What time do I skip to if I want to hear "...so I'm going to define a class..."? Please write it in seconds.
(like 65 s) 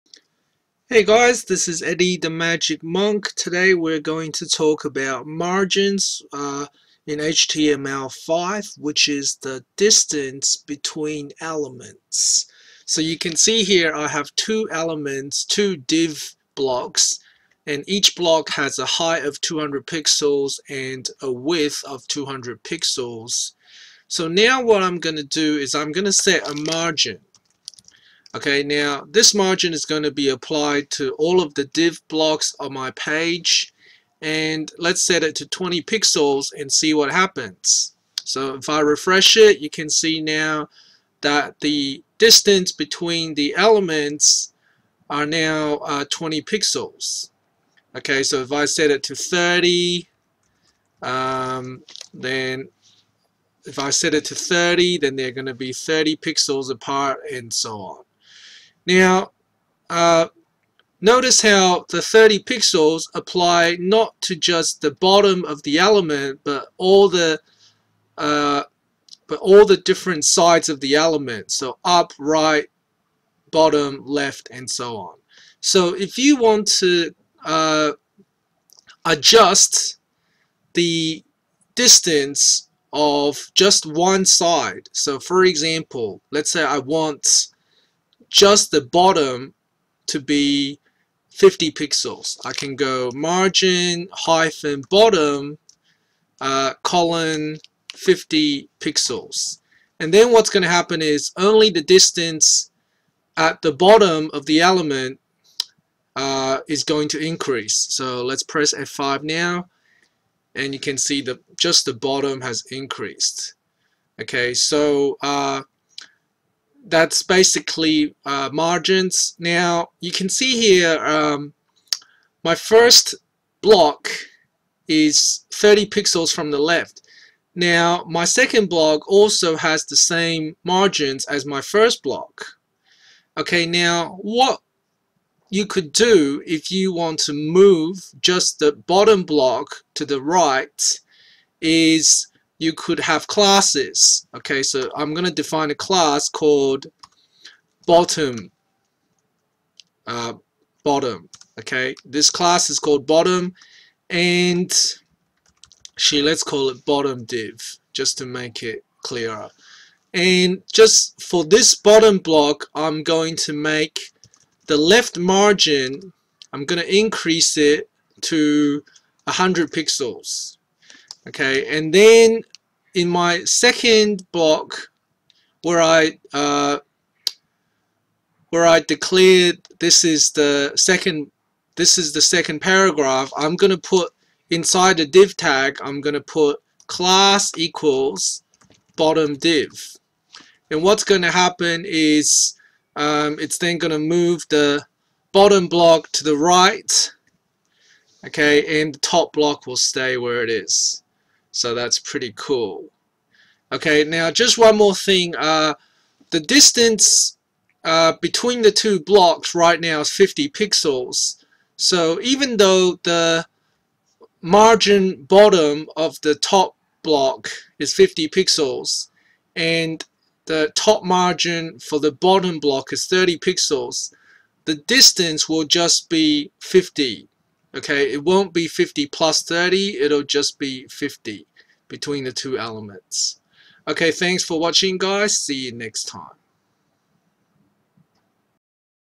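144 s.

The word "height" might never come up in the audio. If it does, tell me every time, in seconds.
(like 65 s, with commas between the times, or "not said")
18 s.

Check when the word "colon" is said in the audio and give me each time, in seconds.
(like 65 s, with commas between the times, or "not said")
96 s.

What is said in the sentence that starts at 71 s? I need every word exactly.
So up, right, bottom, left, and so on.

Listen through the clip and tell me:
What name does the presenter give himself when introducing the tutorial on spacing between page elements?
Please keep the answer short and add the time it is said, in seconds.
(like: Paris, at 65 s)
Eddie the Magic Monk, at 1 s.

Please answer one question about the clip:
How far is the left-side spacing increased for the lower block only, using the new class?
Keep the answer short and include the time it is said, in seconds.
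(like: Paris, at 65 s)
100 pixels, at 169 s.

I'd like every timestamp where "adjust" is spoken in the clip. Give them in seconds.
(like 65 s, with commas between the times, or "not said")
79 s.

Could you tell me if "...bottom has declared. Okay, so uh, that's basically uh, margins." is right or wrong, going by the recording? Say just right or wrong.
wrong.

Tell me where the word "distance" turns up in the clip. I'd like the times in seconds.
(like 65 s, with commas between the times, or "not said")
9 s, 42 s, 81 s, 101 s, 206 s, 224 s.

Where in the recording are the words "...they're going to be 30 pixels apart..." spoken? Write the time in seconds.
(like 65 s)
55 s.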